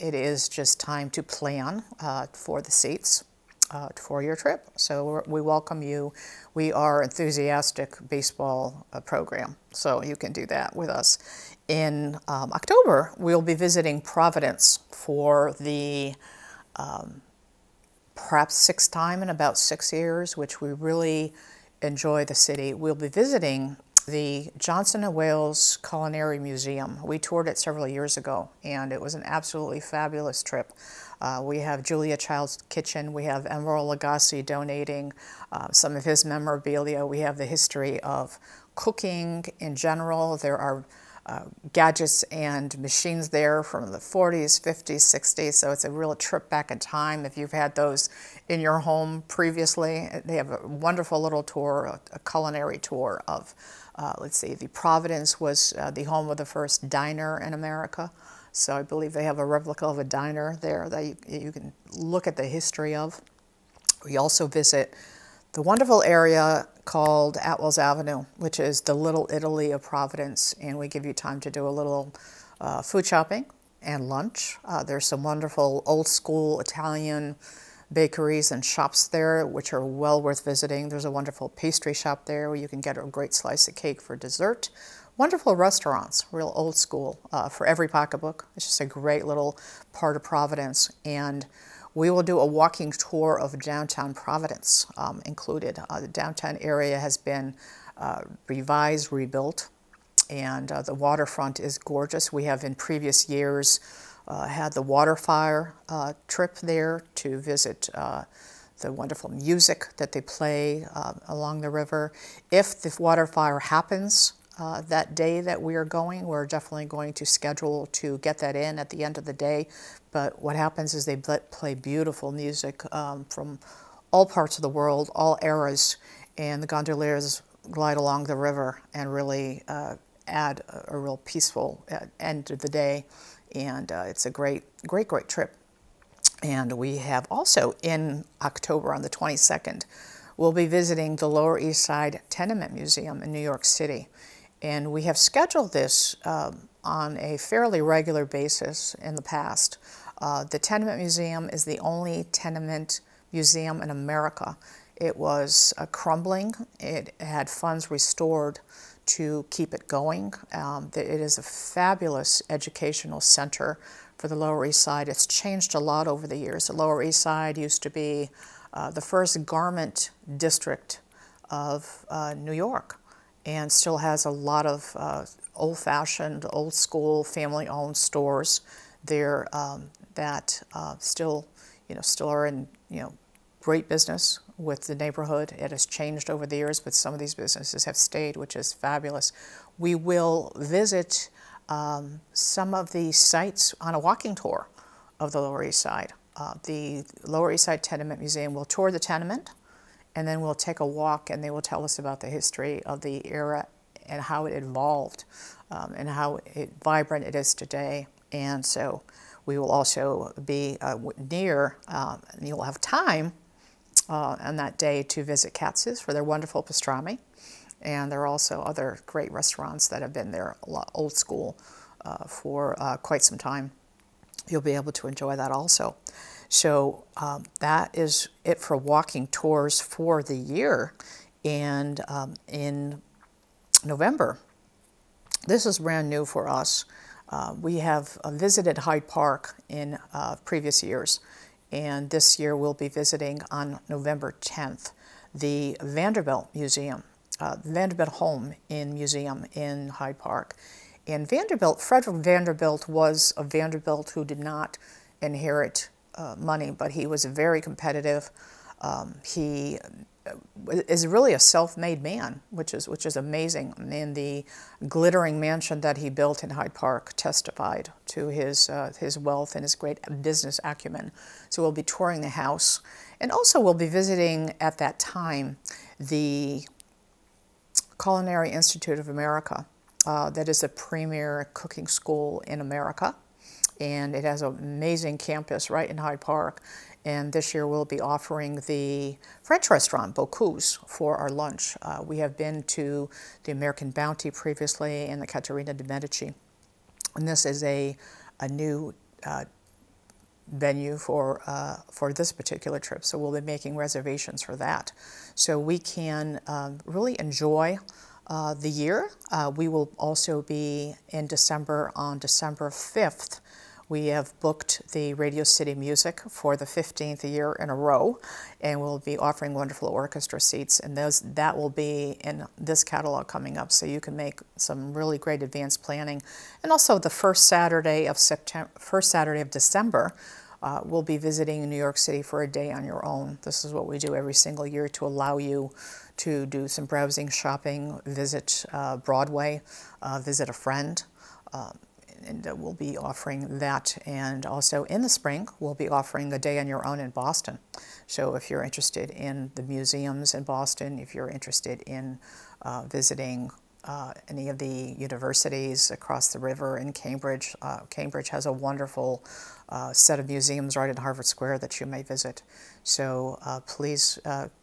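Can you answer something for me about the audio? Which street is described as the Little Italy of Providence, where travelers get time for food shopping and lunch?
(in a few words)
Atwell's Avenue.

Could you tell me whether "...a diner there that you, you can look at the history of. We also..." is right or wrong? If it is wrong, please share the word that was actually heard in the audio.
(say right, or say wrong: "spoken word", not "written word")
right.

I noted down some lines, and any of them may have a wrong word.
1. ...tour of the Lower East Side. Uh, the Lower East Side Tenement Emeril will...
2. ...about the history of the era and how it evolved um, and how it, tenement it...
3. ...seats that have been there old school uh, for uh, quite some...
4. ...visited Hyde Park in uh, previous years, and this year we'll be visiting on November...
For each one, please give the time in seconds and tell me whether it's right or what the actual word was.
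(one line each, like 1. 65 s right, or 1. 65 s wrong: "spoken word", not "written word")
1. 194 s wrong: "Museum", not "Emeril"
2. 201 s wrong: "vibrant", not "tenement"
3. 219 s wrong: "restaurants", not "seats"
4. 238 s right.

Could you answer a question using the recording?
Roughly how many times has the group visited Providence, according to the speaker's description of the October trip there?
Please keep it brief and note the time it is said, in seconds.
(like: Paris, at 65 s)
6, at 18 s.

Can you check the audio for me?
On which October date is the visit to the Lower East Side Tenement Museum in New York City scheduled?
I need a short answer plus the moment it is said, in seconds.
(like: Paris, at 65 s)
October 22, at 138 s.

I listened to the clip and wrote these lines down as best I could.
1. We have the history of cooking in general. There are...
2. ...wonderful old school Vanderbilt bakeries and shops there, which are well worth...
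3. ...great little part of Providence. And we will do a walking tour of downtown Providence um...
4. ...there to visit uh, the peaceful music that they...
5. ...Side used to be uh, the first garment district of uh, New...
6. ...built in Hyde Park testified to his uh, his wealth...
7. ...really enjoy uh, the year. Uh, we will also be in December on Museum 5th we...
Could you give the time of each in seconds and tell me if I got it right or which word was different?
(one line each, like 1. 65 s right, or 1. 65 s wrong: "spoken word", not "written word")
1. 37 s right
2. 75 s wrong: "Italian", not "Vanderbilt"
3. 88 s right
4. 106 s wrong: "wonderful", not "peaceful"
5. 167 s right
6. 266 s right
7. 306 s wrong: "December", not "Museum".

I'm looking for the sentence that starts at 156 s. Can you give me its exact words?
It had funds restored to keep it going.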